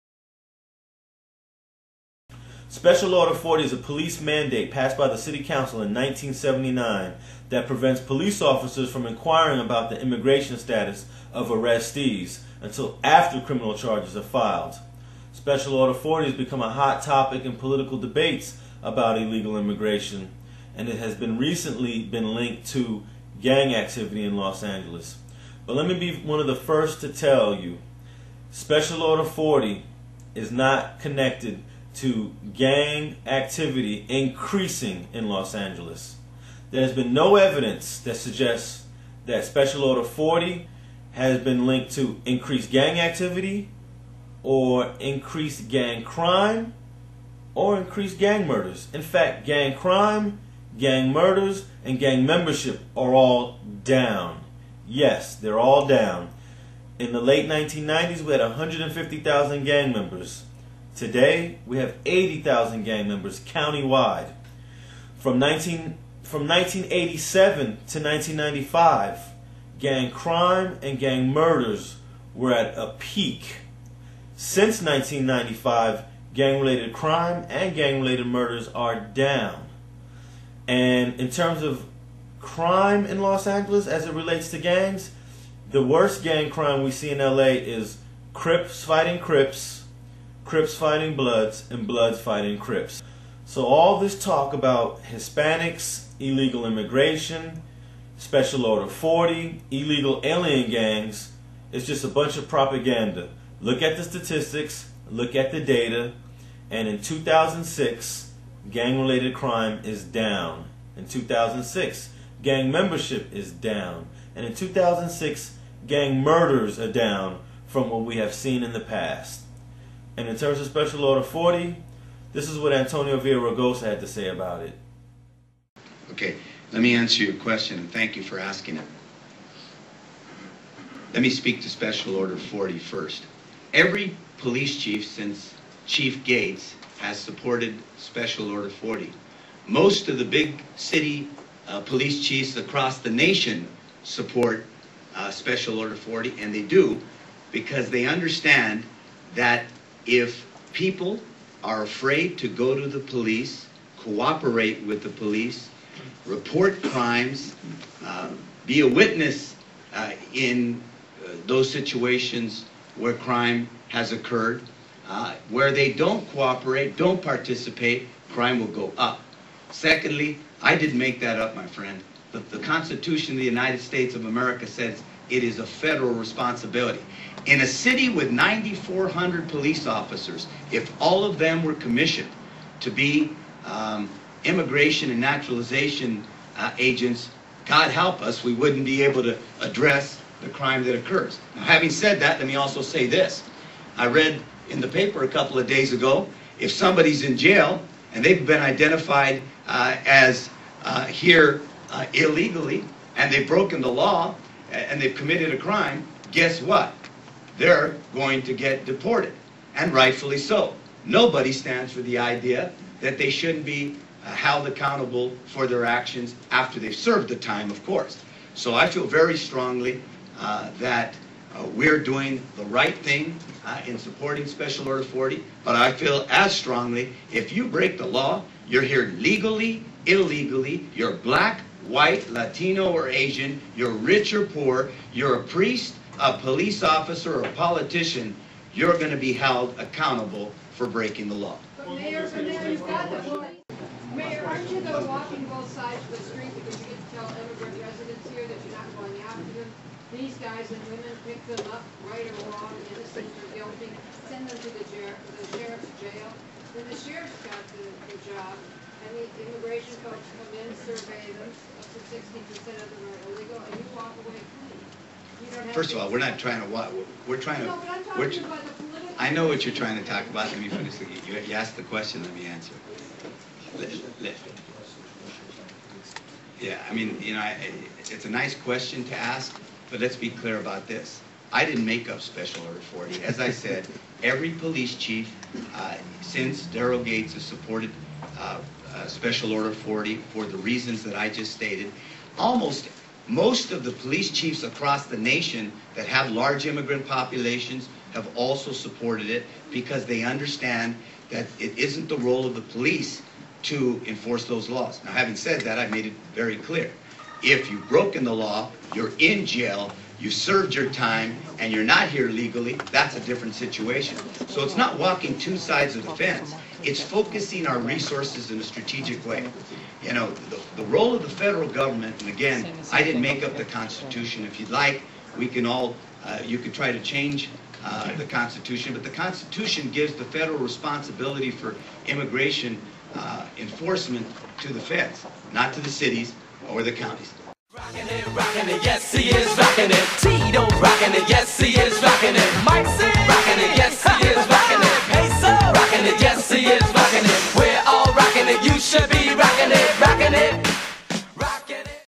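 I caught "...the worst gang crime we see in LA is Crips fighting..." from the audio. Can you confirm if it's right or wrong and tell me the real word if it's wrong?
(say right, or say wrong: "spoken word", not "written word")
right.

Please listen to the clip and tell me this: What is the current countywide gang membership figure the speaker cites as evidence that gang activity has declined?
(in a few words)
80,000.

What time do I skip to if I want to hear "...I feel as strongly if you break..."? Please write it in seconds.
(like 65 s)
225 s.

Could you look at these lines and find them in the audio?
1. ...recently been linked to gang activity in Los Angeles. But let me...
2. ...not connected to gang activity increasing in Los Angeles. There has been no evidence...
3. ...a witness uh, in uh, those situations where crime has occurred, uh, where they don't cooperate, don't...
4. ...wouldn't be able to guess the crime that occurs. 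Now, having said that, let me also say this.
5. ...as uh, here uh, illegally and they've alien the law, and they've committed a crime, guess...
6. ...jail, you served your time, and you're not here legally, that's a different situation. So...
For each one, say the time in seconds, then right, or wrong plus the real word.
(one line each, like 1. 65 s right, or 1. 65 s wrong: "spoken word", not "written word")
1. 21 s right
2. 30 s right
3. 158 s right
4. 188 s wrong: "address", not "guess"
5. 200 s wrong: "broken", not "alien"
6. 309 s right.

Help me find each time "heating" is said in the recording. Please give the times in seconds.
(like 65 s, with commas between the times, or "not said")
not said.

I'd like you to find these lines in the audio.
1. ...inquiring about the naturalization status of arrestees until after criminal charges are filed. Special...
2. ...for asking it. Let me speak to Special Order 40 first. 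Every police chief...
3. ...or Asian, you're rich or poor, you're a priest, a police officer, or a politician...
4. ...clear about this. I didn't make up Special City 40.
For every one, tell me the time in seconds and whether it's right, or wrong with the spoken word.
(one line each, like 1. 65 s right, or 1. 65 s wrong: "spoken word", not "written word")
1. 9 s wrong: "immigration", not "naturalization"
2. 128 s right
3. 232 s right
4. 280 s wrong: "Order", not "City".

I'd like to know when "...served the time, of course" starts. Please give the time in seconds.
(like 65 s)
216 s.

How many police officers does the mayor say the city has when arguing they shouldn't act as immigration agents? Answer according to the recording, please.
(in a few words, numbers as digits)
9,400.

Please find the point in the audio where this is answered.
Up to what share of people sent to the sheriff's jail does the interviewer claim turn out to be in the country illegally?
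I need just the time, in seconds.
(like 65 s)
262 s.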